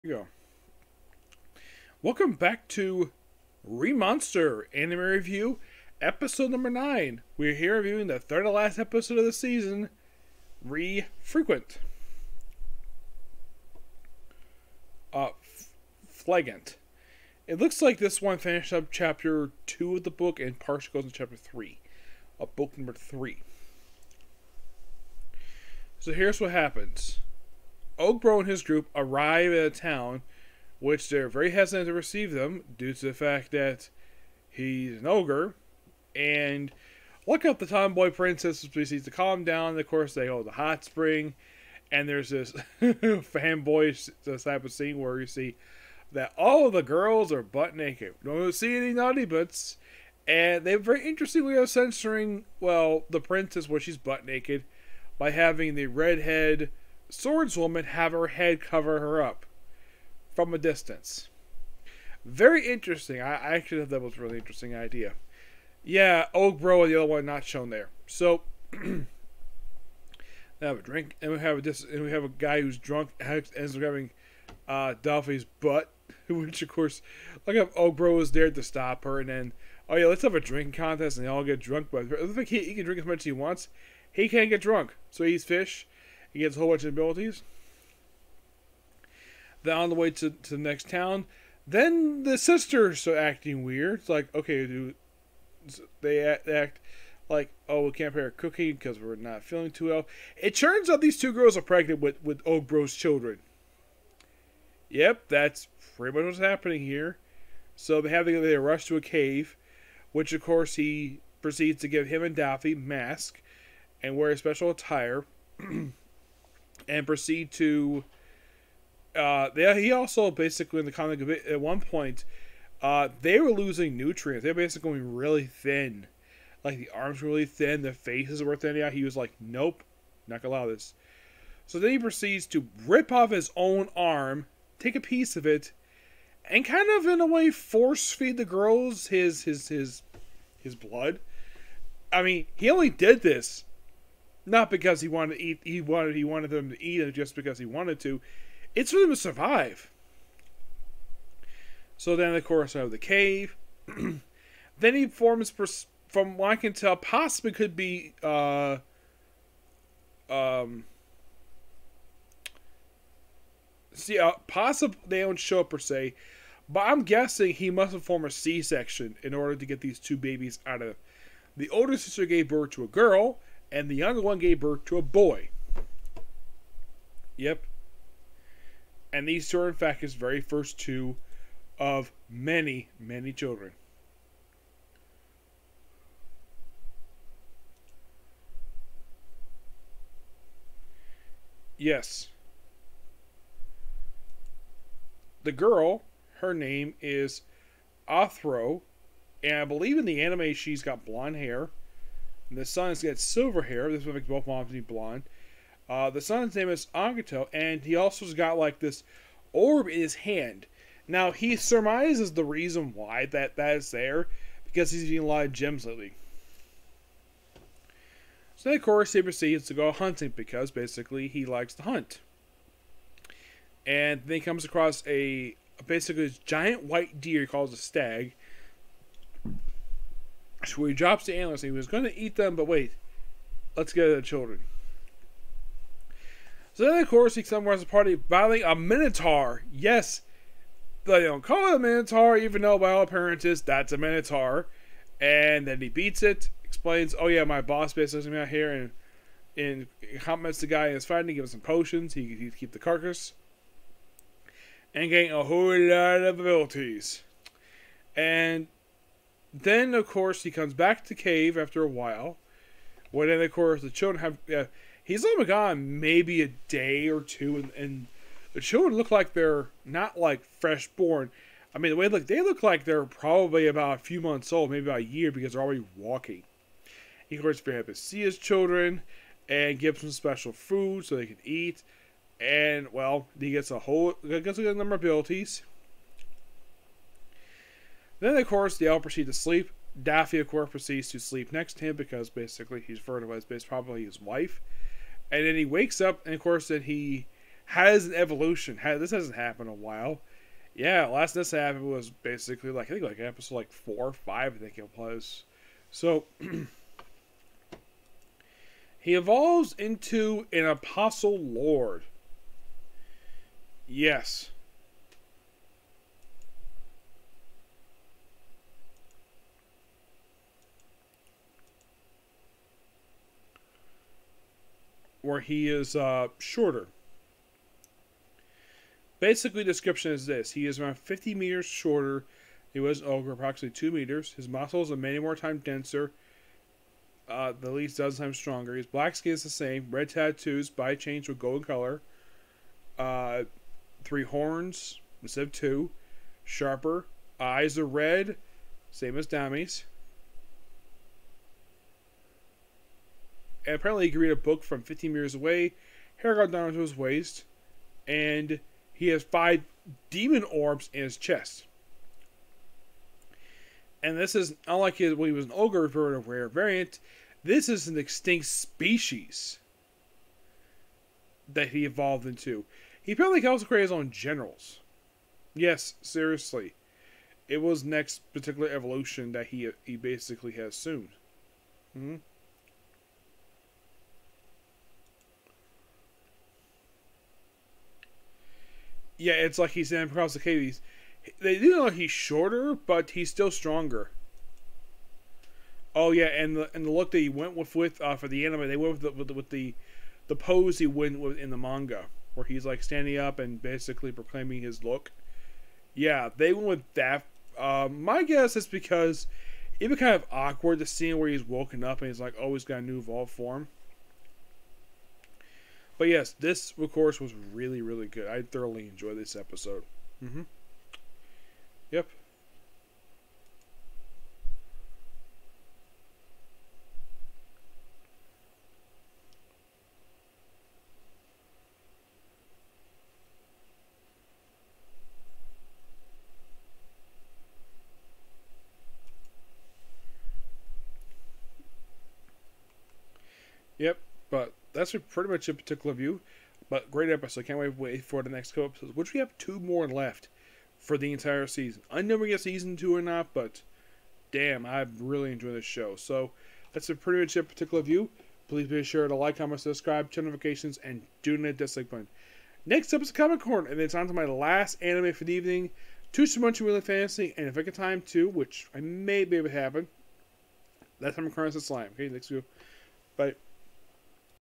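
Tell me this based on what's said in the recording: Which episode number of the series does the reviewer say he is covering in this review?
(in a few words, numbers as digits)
9.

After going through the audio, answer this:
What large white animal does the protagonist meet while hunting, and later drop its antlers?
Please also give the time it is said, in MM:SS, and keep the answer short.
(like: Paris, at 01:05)
stag, at 03:47.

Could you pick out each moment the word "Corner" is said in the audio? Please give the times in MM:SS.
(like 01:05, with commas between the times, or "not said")
07:43, 07:51.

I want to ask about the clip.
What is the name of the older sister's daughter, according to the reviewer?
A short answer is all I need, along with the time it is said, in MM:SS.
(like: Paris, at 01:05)
Othro, at 03:18.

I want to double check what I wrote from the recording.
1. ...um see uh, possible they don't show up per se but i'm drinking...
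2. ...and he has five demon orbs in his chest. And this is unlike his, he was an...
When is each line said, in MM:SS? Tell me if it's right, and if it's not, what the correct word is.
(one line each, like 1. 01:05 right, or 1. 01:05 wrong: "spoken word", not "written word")
1. 02:40 wrong: "guessing", not "drinking"
2. 05:58 right.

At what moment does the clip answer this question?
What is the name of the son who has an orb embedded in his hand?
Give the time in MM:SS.
03:26.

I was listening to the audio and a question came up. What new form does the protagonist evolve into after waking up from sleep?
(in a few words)
apostle lord.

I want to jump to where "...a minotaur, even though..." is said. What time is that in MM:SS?
04:01.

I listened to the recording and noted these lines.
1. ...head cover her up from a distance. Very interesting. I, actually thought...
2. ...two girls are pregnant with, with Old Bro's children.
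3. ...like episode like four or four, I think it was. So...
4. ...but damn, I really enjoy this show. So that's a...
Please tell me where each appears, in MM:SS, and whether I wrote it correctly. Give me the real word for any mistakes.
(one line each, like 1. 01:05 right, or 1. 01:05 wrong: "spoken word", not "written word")
1. 00:58 right
2. 01:41 right
3. 05:03 wrong: "five", not "four"
4. 07:33 right.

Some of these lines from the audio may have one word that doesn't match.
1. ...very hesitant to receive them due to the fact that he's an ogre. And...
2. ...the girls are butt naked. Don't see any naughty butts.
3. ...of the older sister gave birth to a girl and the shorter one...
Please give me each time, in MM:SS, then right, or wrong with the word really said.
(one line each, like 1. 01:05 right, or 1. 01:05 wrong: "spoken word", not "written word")
1. 00:31 right
2. 00:46 right
3. 02:50 wrong: "younger", not "shorter".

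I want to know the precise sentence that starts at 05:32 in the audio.
He was over approximately two meters.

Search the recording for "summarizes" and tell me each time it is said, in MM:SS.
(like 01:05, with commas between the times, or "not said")
03:57.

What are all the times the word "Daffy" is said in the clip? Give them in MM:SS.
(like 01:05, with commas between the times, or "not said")
01:52, 04:50.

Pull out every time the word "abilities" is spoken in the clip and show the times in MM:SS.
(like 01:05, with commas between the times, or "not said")
01:26, 04:16, 04:45.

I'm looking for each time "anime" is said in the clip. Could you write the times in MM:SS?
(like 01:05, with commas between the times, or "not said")
00:04, 03:20, 06:38, 07:44.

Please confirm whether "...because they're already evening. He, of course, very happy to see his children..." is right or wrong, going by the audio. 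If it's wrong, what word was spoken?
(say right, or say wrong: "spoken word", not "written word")
wrong: "walking", not "evening".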